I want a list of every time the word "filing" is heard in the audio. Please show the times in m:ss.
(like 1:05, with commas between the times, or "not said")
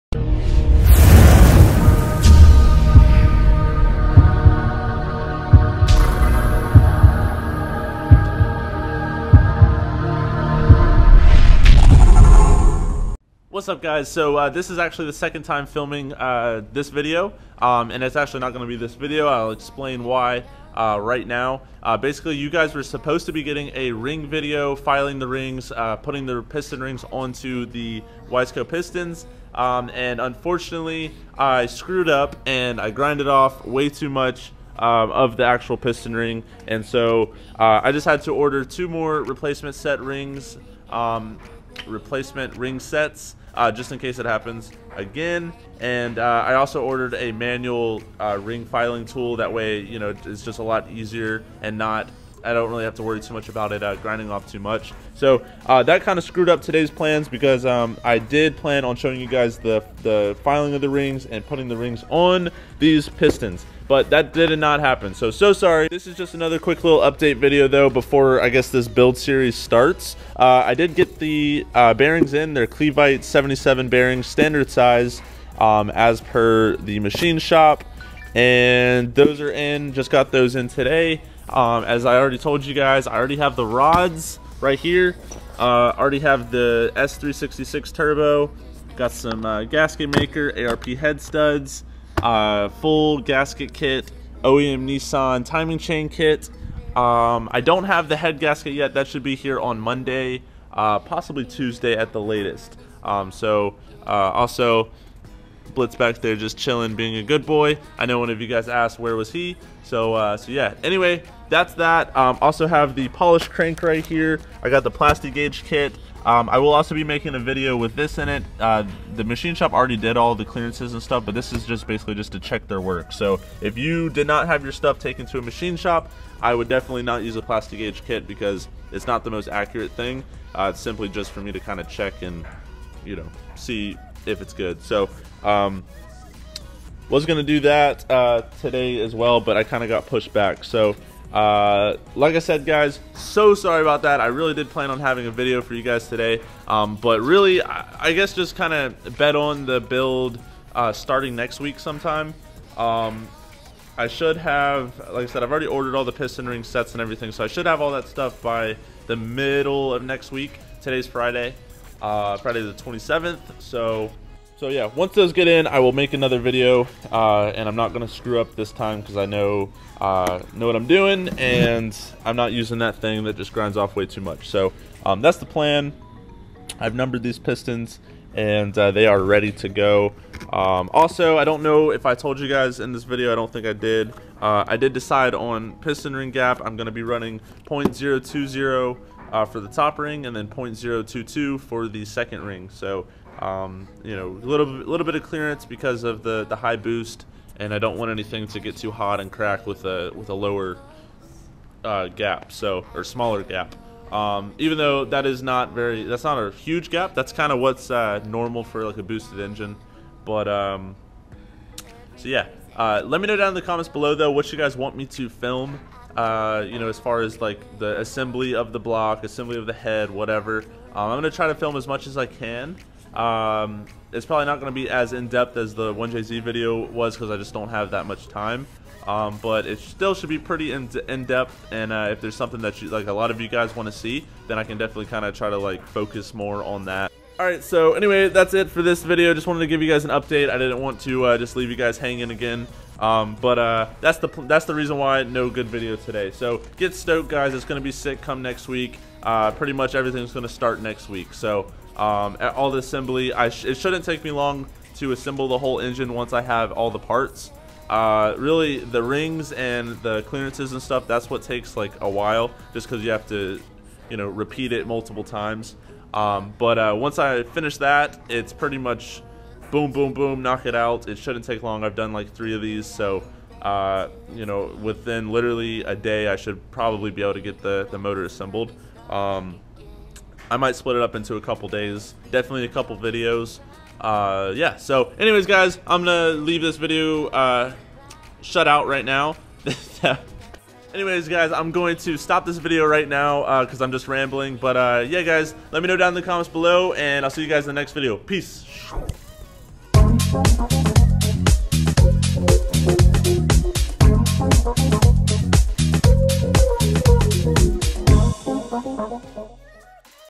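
0:24, 0:48, 1:00.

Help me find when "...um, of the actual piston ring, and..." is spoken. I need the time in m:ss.
0:34.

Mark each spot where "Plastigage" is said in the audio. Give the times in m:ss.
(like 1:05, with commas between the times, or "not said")
1:54, 2:07.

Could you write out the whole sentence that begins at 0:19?
I'll explain why uh, right now.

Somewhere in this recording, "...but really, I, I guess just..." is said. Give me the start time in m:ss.
2:26.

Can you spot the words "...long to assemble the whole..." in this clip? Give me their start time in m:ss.
4:14.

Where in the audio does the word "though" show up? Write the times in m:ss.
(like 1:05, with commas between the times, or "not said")
1:07, 3:24, 3:34.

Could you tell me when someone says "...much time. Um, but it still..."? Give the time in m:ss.
3:48.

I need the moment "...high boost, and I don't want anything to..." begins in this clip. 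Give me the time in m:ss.
3:16.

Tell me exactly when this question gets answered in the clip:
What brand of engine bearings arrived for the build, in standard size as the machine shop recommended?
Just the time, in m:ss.
1:12.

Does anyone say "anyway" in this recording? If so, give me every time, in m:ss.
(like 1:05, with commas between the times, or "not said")
1:50, 3:57, 4:45, 4:50.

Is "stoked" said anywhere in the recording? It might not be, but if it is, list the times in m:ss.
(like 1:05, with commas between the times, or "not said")
4:06.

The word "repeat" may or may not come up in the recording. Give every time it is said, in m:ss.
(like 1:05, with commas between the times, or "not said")
4:24.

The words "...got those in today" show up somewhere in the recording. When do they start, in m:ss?
1:20.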